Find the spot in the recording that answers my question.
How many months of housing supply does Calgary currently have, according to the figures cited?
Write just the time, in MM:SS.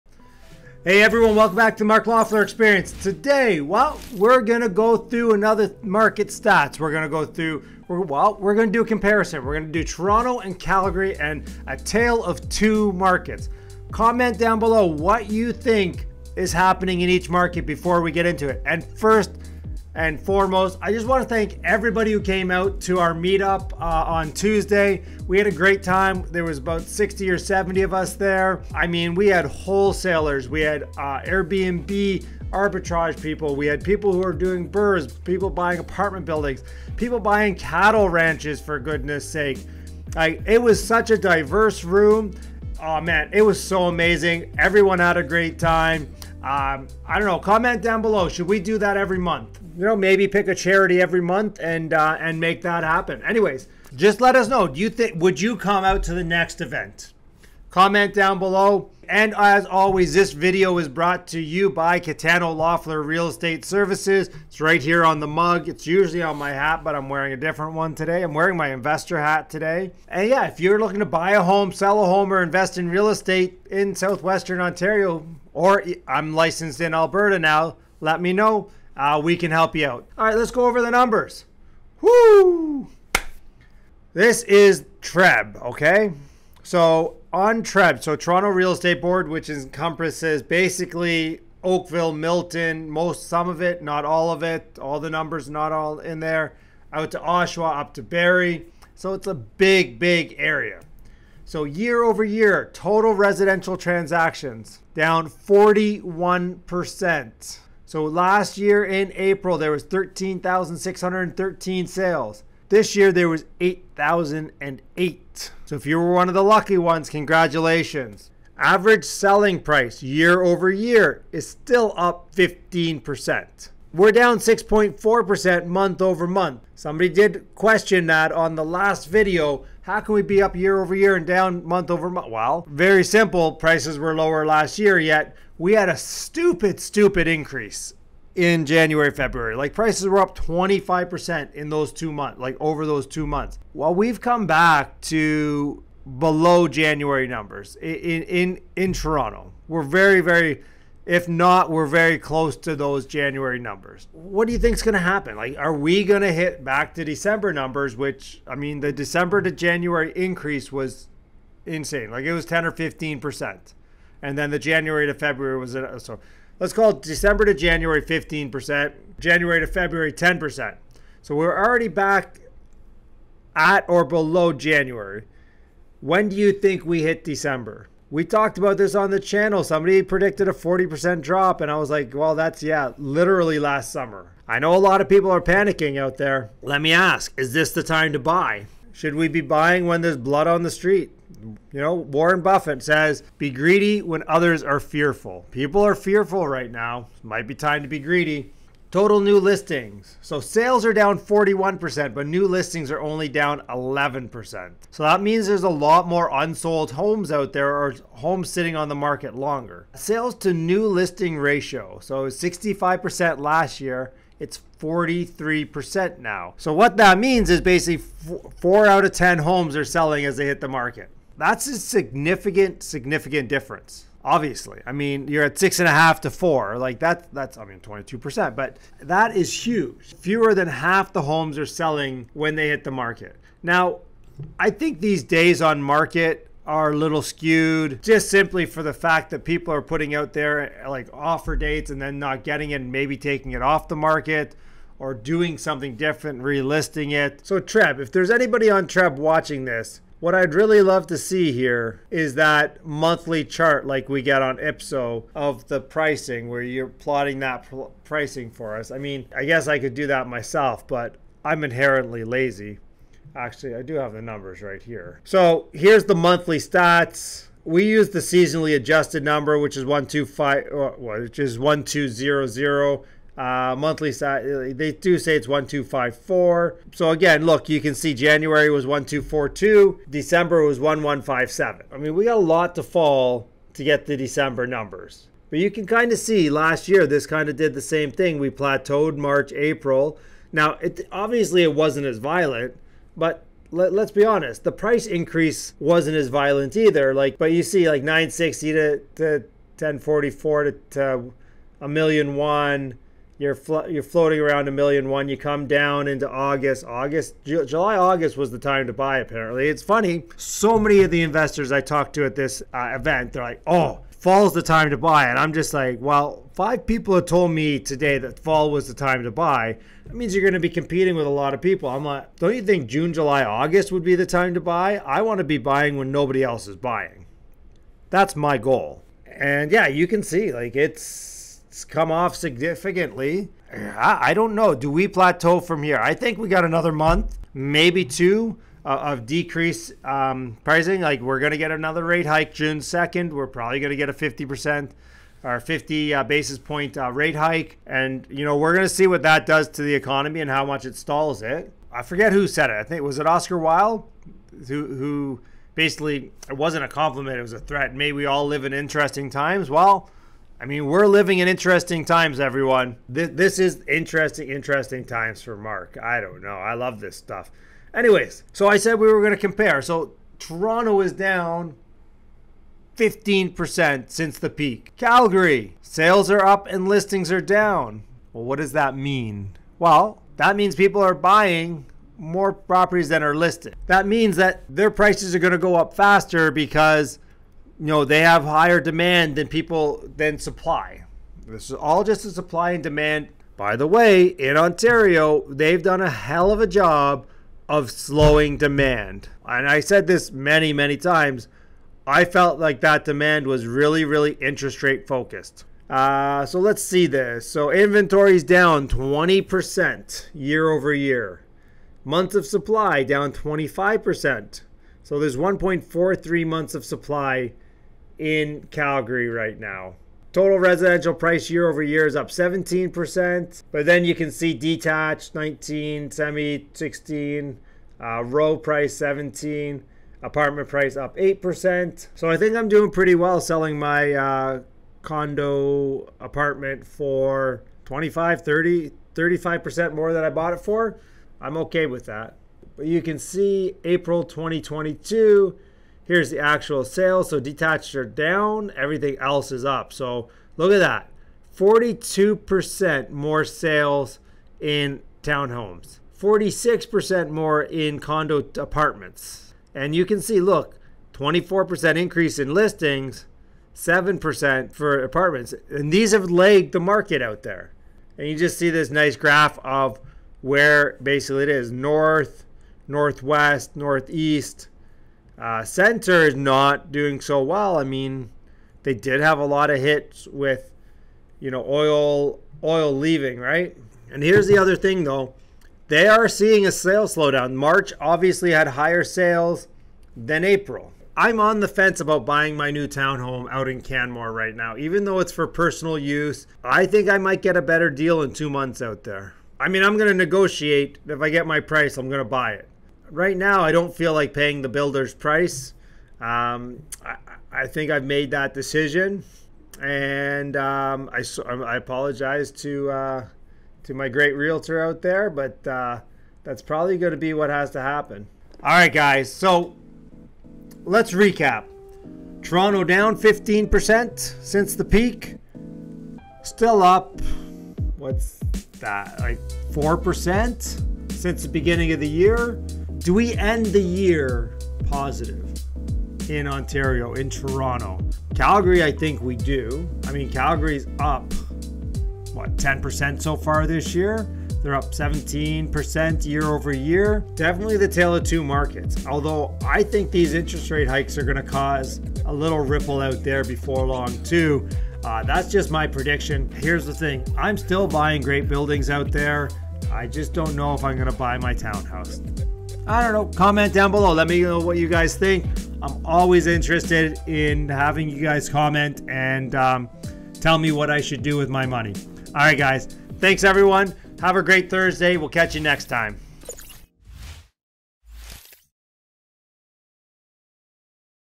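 06:55.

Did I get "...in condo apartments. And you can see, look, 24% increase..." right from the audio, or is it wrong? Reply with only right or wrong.
right.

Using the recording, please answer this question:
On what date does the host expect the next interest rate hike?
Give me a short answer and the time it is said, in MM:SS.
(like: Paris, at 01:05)
June 2nd, at 05:42.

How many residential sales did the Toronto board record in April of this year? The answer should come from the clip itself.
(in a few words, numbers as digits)
8,008.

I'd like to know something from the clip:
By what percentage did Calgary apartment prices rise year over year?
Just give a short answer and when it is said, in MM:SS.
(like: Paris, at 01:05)
8%, at 07:11.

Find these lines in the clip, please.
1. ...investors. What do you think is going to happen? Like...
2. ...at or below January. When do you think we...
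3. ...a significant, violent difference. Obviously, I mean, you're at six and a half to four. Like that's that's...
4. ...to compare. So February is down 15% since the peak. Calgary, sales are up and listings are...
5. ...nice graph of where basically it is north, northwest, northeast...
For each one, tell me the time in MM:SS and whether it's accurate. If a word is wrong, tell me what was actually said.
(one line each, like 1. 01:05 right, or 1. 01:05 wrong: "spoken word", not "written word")
1. 02:33 wrong: "numbers", not "investors"
2. 02:53 right
3. 03:41 wrong: "significant", not "violent"
4. 06:09 wrong: "Toronto", not "February"
5. 07:48 right.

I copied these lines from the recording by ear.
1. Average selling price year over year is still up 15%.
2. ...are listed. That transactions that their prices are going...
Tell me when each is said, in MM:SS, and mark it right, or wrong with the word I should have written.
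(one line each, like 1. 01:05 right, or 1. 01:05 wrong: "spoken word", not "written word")
1. 01:58 right
2. 06:23 wrong: "means", not "transactions".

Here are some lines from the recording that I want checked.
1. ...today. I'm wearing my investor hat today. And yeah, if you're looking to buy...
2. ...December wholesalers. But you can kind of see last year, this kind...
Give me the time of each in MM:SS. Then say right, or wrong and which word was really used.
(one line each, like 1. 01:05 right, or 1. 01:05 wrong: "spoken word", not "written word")
1. 01:07 right
2. 04:44 wrong: "numbers", not "wholesalers".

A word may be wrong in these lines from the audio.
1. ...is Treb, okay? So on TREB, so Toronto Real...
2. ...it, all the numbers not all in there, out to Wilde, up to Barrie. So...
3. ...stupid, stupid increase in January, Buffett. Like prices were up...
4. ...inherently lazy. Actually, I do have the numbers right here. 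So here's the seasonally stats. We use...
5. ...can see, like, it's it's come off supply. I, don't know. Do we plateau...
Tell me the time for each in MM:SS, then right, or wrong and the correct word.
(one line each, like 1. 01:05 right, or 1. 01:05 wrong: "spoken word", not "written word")
1. 01:24 right
2. 01:34 wrong: "Oshawa", not "Wilde"
3. 02:15 wrong: "February", not "Buffett"
4. 04:21 wrong: "monthly", not "seasonally"
5. 05:30 wrong: "significantly", not "supply".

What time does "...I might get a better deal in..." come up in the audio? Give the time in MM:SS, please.
08:17.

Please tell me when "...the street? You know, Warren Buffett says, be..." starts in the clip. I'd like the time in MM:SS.
03:10.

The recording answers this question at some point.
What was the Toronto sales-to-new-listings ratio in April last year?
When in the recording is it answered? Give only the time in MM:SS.
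03:32.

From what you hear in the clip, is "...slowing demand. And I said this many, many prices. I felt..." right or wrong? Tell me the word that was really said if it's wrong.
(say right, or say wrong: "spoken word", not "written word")
wrong: "times", not "prices".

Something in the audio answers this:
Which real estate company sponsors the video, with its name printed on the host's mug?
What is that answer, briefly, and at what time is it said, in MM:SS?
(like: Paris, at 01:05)
Catano Loeffler Real Estate Services, at 01:01.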